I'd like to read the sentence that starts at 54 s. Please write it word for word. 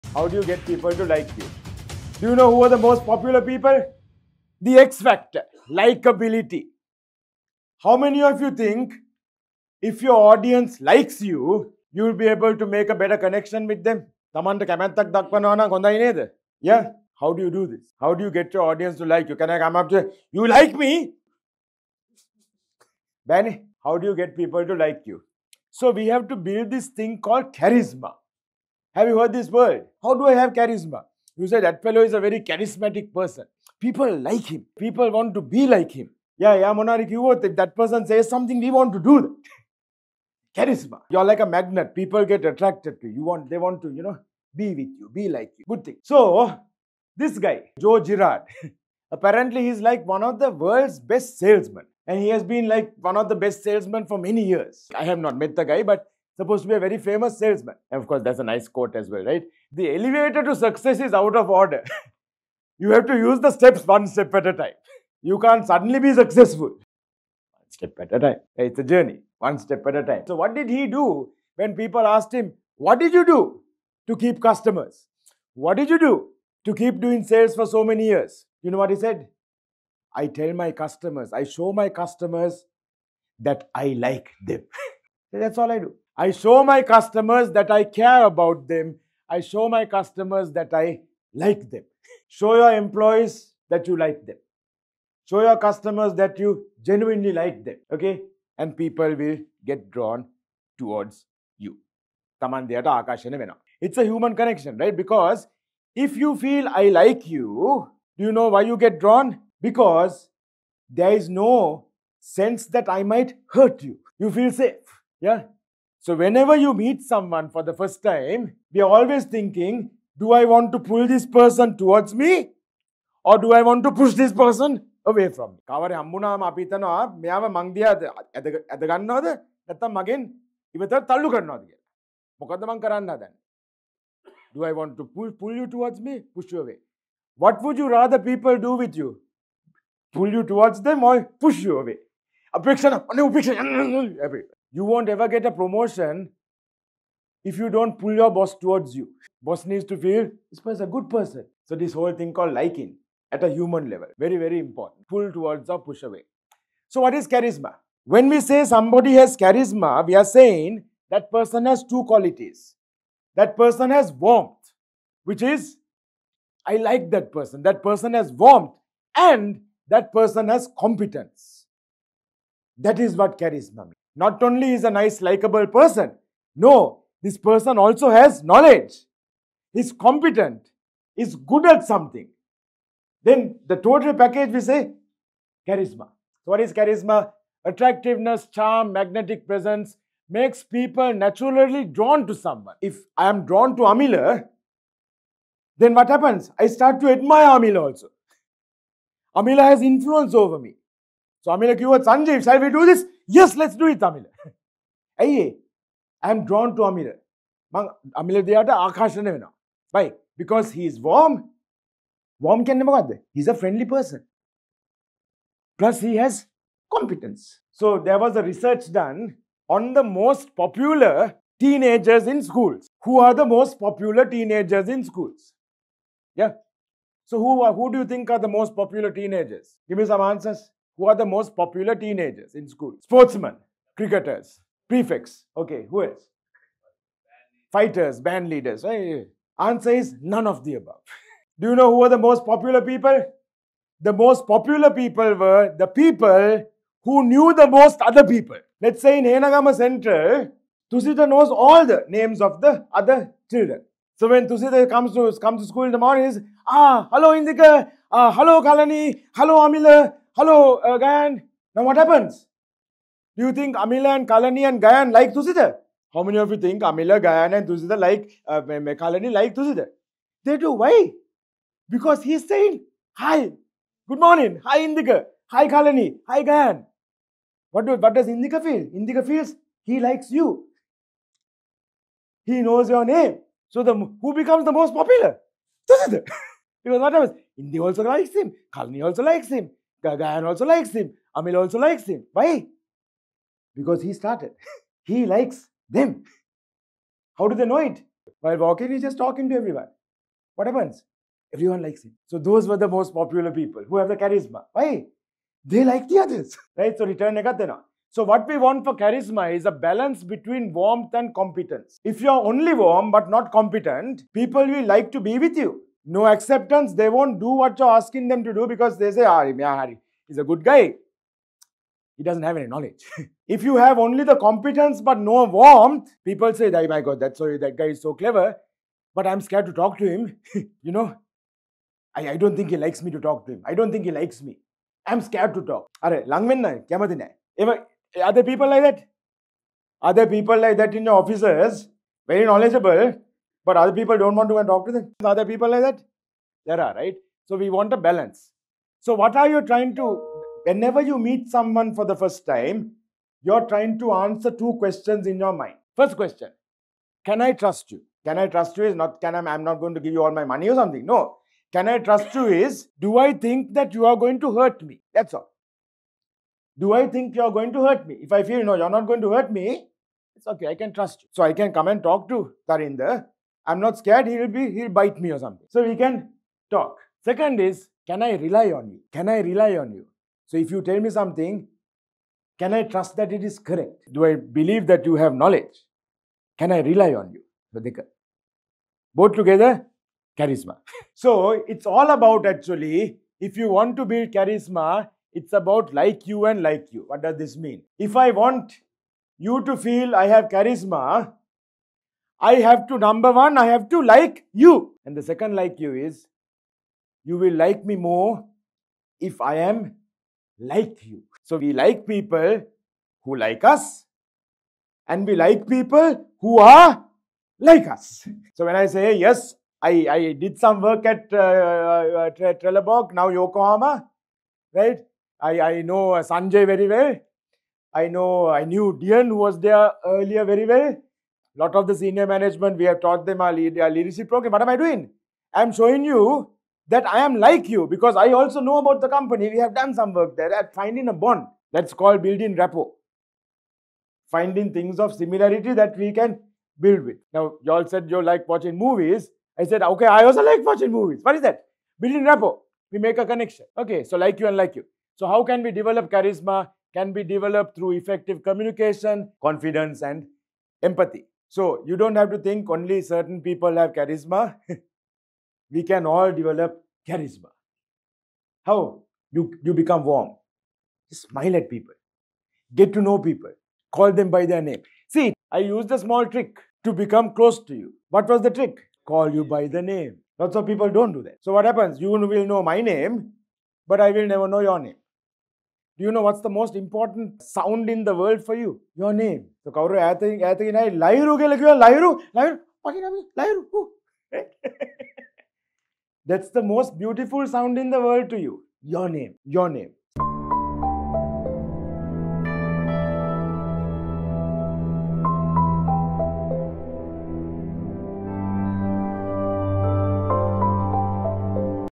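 I have not met the guy, but supposed to be a very famous salesman.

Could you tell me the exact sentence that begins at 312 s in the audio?
If you are only warm but not competent, people will like to be with you no acceptance.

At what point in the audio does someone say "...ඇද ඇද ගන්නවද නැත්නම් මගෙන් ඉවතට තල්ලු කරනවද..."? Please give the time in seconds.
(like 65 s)
128 s.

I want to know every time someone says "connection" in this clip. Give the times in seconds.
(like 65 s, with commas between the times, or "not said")
13 s, 104 s, 453 s.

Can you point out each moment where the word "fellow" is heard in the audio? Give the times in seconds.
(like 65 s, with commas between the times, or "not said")
31 s.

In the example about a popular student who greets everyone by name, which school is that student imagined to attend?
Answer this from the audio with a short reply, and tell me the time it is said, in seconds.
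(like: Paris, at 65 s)
Henegama Central, at 249 s.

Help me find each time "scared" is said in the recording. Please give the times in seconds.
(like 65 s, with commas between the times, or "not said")
329 s, 335 s, 373 s.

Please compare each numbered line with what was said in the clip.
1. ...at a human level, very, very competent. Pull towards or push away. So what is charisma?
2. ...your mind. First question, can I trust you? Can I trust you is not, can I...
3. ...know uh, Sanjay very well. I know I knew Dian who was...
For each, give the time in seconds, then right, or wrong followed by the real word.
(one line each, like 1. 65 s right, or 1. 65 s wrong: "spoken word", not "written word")
1. 153 s wrong: "important", not "competent"
2. 355 s right
3. 425 s right.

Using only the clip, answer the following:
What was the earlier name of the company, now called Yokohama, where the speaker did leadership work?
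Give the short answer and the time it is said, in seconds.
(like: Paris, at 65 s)
Trelleborg, at 422 s.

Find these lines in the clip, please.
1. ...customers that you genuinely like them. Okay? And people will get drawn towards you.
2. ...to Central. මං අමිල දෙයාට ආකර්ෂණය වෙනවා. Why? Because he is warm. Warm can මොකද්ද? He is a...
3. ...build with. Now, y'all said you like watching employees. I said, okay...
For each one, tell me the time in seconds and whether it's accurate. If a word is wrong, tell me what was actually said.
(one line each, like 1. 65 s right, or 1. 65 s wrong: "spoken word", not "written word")
1. 95 s right
2. 206 s wrong: "Amir", not "Central"
3. 446 s wrong: "movies", not "employees".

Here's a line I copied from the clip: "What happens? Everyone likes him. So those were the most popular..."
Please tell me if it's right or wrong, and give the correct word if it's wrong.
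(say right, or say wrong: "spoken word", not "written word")
right.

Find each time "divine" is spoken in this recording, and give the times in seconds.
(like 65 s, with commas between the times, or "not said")
not said.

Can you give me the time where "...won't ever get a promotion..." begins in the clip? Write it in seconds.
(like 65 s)
144 s.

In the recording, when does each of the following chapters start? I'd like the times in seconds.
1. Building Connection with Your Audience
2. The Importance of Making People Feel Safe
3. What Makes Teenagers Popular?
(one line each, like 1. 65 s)
1. 12 s
2. 120 s
3. 230 s.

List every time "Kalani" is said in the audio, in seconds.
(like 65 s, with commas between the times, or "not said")
258 s, 264 s, 268 s, 275 s, 288 s.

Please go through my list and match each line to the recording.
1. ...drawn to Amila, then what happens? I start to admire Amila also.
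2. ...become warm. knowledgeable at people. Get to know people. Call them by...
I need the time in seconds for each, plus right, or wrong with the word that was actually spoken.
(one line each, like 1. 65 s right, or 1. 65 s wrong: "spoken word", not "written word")
1. 193 s right
2. 469 s wrong: "smile", not "knowledgeable".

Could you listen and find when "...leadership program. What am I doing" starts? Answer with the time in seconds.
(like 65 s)
433 s.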